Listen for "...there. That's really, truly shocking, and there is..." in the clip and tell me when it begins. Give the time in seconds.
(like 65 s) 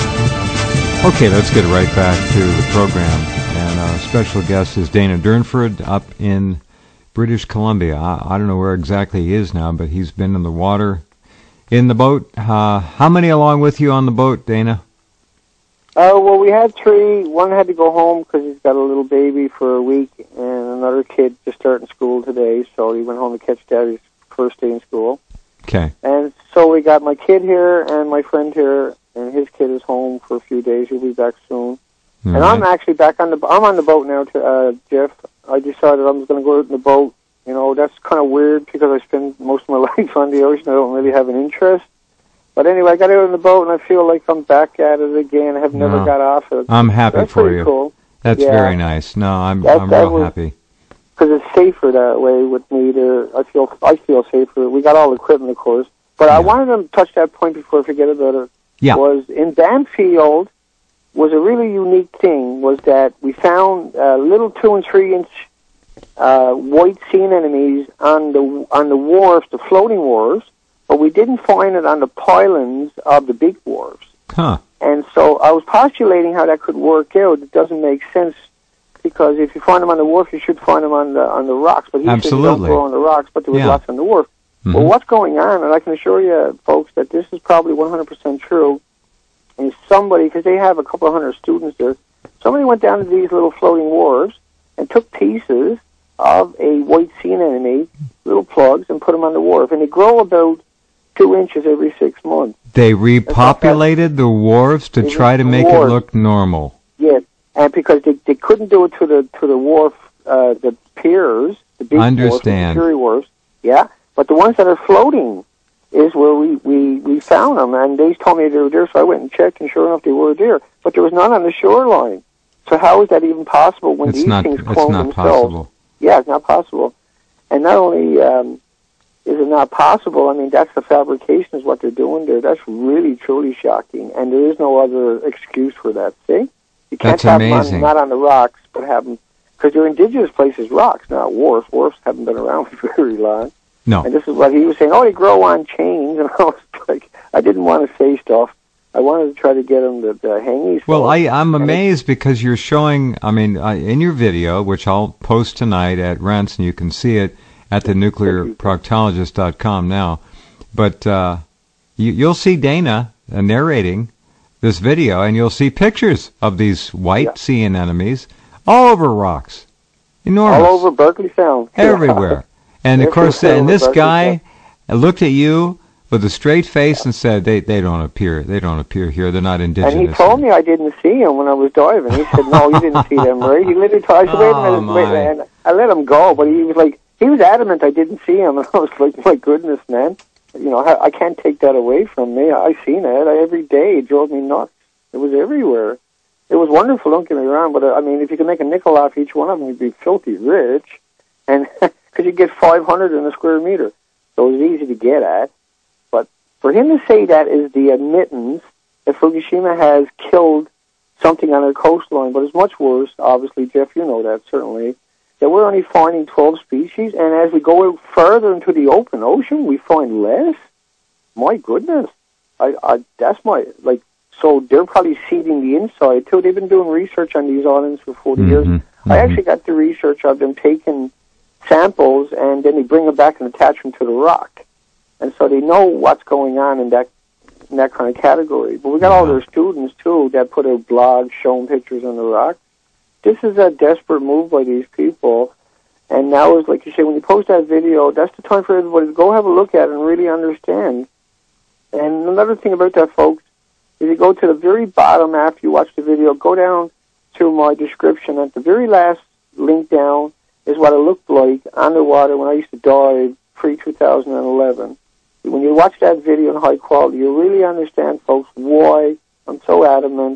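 132 s.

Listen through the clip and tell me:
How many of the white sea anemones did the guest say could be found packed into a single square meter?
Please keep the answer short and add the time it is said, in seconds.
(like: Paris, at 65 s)
500, at 202 s.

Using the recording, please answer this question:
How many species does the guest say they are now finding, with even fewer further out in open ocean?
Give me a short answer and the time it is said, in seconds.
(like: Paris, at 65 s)
12, at 216 s.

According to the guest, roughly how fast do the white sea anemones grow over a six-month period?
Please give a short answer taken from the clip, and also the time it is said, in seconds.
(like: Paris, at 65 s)
2 inches, at 101 s.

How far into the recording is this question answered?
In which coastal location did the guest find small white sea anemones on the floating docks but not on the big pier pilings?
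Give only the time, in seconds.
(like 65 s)
59 s.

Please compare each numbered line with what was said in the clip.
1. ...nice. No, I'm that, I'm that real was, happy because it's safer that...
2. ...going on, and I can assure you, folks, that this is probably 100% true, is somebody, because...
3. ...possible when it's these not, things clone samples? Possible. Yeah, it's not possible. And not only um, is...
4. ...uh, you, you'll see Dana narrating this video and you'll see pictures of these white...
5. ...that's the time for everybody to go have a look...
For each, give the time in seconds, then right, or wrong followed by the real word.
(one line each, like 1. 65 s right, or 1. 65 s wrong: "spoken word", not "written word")
1. 48 s right
2. 85 s right
3. 123 s wrong: "themselves", not "samples"
4. 161 s right
5. 248 s right.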